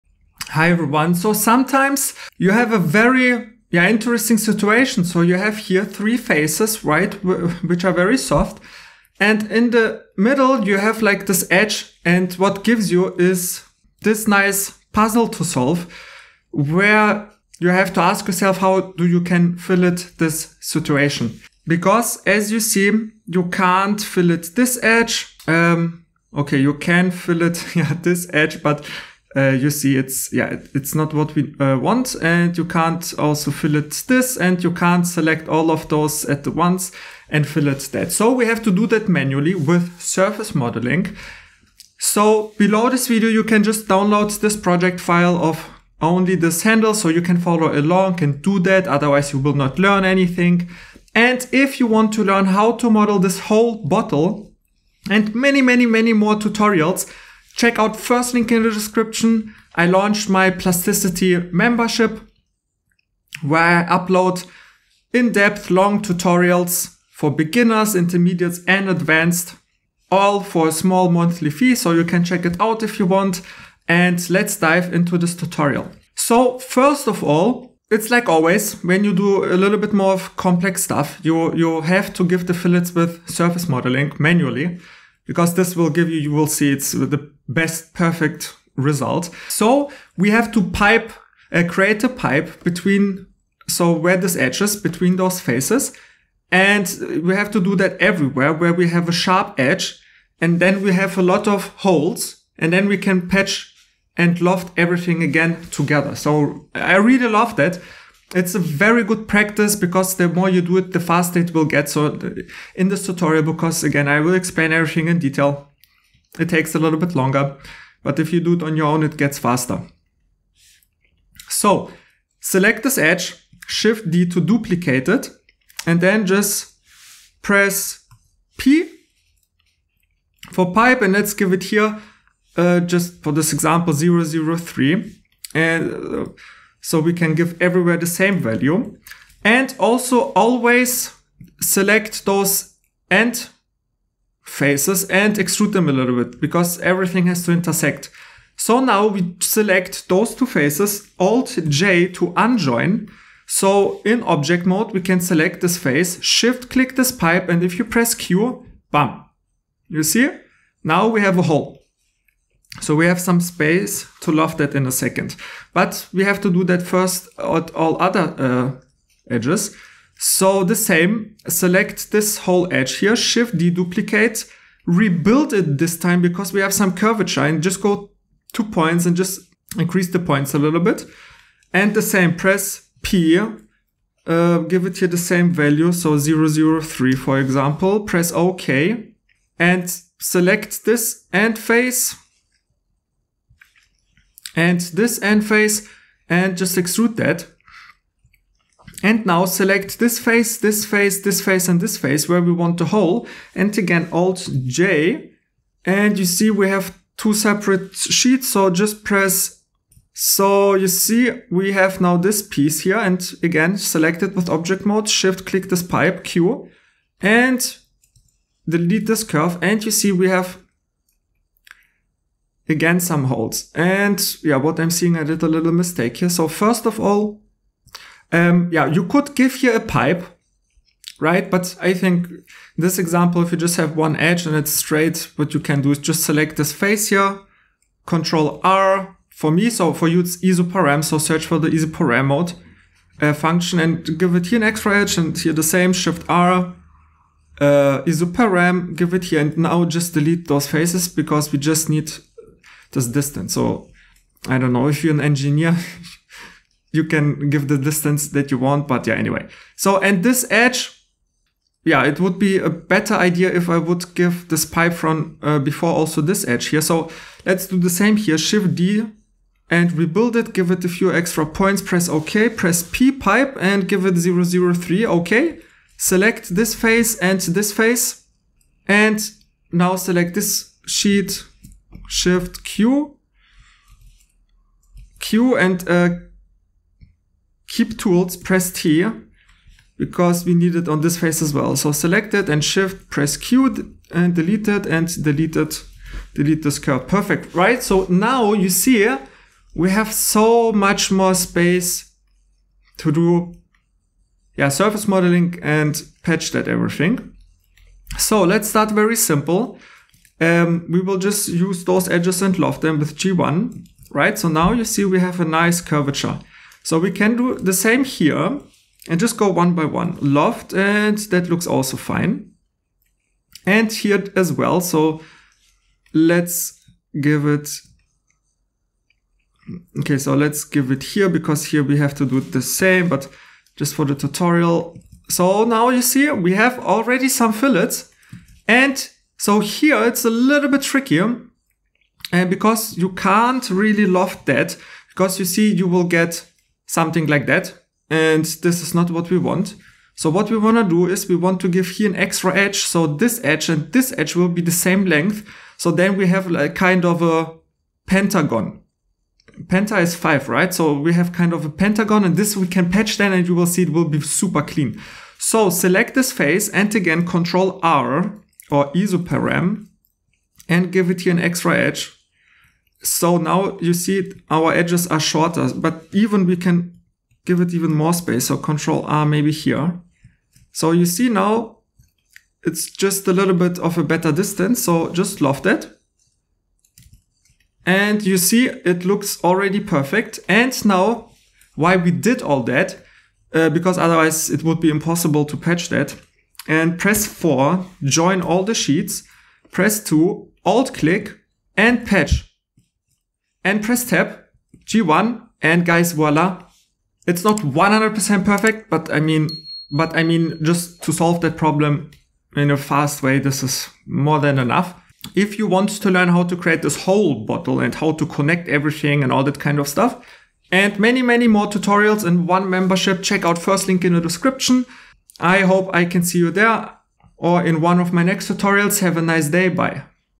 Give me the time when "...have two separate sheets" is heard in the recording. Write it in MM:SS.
03:26.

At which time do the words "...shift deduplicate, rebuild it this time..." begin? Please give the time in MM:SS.
02:53.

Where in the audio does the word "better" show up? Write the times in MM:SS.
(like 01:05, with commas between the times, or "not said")
04:22, 06:24.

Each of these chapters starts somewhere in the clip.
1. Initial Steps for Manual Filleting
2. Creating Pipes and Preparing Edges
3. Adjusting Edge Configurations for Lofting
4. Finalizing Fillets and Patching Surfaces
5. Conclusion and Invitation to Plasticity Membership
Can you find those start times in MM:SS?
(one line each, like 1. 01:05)
1. 01:16
2. 02:01
3. 03:44
4. 05:02
5. 06:47.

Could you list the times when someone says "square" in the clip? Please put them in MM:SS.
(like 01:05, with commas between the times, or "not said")
not said.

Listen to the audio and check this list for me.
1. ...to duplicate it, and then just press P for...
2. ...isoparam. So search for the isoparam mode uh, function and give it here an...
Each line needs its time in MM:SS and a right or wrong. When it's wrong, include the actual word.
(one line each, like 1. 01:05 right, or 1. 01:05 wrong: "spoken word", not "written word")
1. 02:04 right
2. 04:00 right.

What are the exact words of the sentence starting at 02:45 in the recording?
But we have to do that first at all other uh, edges.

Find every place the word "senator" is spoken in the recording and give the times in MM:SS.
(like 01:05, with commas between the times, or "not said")
not said.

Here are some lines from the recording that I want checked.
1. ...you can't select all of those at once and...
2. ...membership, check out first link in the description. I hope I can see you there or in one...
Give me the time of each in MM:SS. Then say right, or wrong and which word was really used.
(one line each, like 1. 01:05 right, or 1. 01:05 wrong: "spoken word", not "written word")
1. 00:34 right
2. 07:02 right.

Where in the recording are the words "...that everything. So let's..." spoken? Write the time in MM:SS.
05:06.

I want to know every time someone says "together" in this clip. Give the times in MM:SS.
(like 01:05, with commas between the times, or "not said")
01:45.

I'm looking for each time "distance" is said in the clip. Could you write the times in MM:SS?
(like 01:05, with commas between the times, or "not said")
04:13, 04:17, 06:24.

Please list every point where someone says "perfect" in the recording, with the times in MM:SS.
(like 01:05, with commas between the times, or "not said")
01:27, 04:57, 06:29, 06:48.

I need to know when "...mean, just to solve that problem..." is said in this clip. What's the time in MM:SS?
06:50.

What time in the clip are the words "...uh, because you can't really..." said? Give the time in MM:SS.
05:42.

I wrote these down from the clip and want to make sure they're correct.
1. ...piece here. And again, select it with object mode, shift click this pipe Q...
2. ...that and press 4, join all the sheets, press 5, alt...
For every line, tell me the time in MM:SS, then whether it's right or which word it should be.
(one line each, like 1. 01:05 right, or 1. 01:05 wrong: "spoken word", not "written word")
1. 03:32 right
2. 06:35 wrong: "2", not "5".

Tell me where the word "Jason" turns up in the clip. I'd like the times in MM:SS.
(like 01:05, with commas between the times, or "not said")
not said.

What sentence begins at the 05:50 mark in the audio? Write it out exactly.
So what we want to do is we want to give here an extra edge.